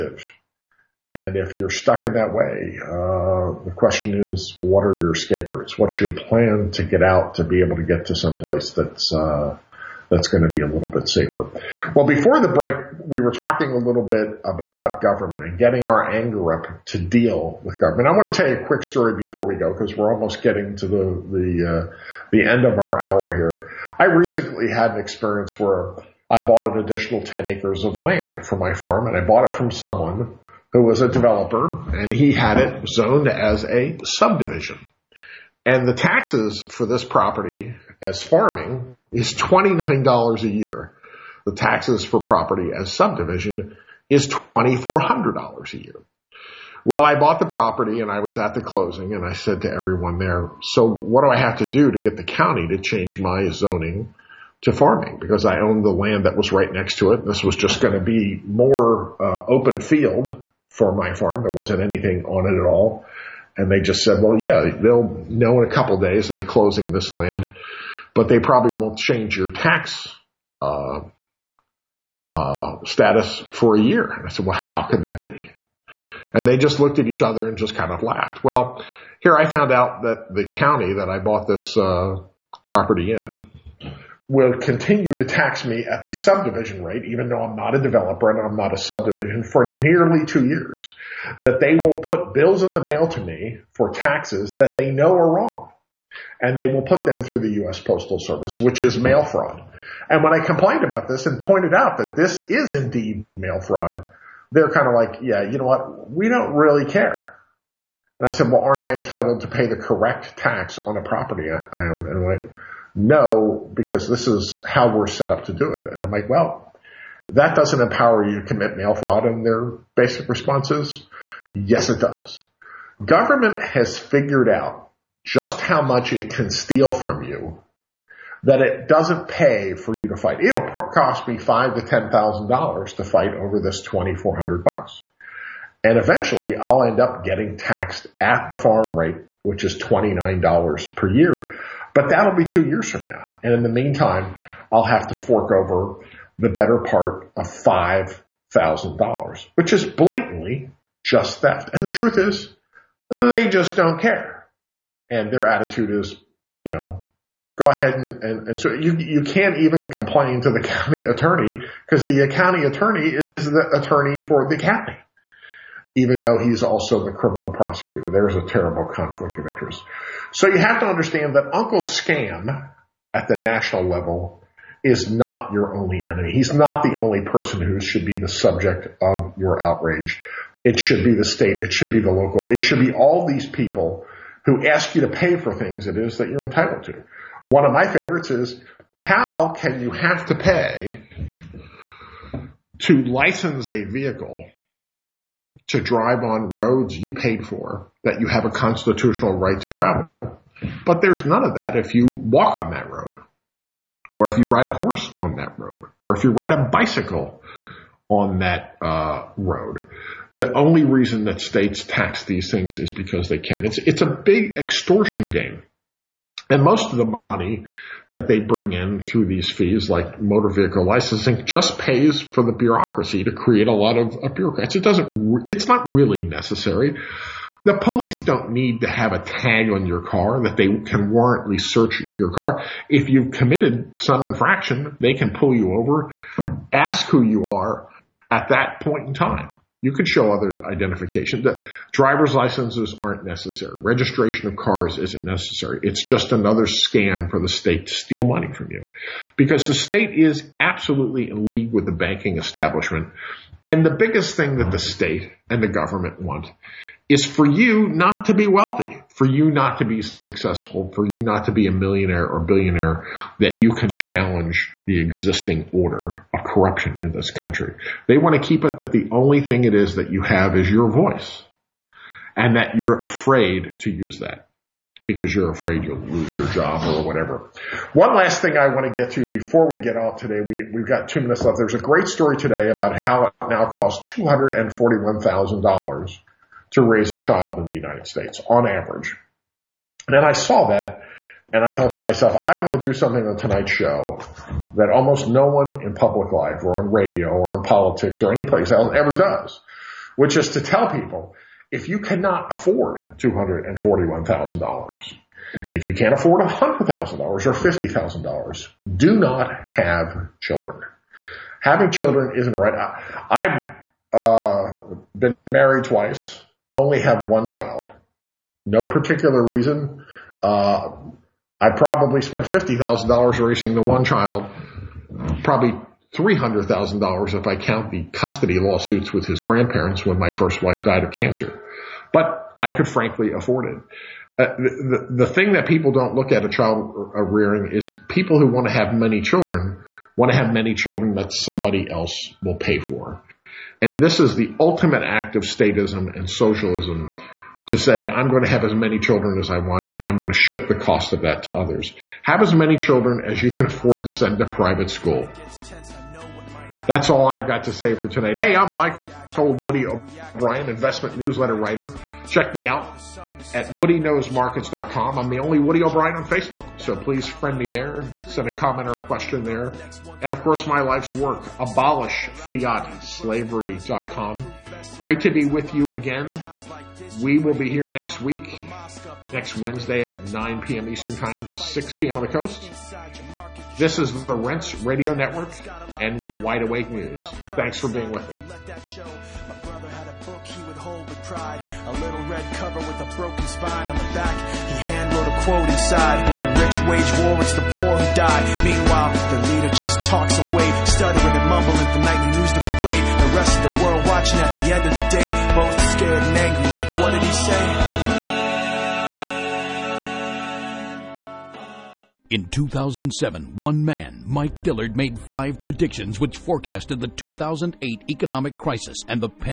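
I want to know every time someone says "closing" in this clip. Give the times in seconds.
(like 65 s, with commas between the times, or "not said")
48 s, 66 s.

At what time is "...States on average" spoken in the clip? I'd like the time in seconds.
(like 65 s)
288 s.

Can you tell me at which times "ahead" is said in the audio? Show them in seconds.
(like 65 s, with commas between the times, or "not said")
157 s.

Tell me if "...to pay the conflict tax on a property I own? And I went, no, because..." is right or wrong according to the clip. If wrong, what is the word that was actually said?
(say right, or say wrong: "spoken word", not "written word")
wrong: "correct", not "conflict".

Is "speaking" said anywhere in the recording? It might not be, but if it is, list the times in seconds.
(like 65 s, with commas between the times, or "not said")
not said.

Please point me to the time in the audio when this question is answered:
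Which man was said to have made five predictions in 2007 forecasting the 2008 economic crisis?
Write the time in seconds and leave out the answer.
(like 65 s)
414 s.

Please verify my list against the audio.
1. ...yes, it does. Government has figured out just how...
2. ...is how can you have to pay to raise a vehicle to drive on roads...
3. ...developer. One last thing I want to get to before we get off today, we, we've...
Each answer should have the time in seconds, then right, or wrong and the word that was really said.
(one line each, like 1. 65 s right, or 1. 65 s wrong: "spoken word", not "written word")
1. 121 s right
2. 188 s wrong: "license", not "raise"
3. 277 s wrong: "whatever", not "developer".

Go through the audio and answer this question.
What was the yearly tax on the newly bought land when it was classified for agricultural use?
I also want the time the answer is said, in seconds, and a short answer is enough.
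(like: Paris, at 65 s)
$29, at 39 s.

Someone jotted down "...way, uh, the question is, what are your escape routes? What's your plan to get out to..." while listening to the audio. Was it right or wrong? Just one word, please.
right.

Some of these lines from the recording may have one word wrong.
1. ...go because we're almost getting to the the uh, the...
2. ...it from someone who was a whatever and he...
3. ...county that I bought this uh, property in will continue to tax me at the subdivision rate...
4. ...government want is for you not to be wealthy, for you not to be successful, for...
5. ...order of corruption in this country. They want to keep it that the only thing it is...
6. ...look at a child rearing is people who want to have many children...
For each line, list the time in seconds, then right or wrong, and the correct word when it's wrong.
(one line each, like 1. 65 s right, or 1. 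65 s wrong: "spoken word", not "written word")
1. 19 s right
2. 29 s wrong: "developer", not "whatever"
3. 80 s right
4. 255 s right
5. 265 s right
6. 336 s right.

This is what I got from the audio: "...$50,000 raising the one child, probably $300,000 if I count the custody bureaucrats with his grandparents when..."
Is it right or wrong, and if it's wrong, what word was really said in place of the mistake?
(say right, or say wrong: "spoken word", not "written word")
wrong: "lawsuits", not "bureaucrats".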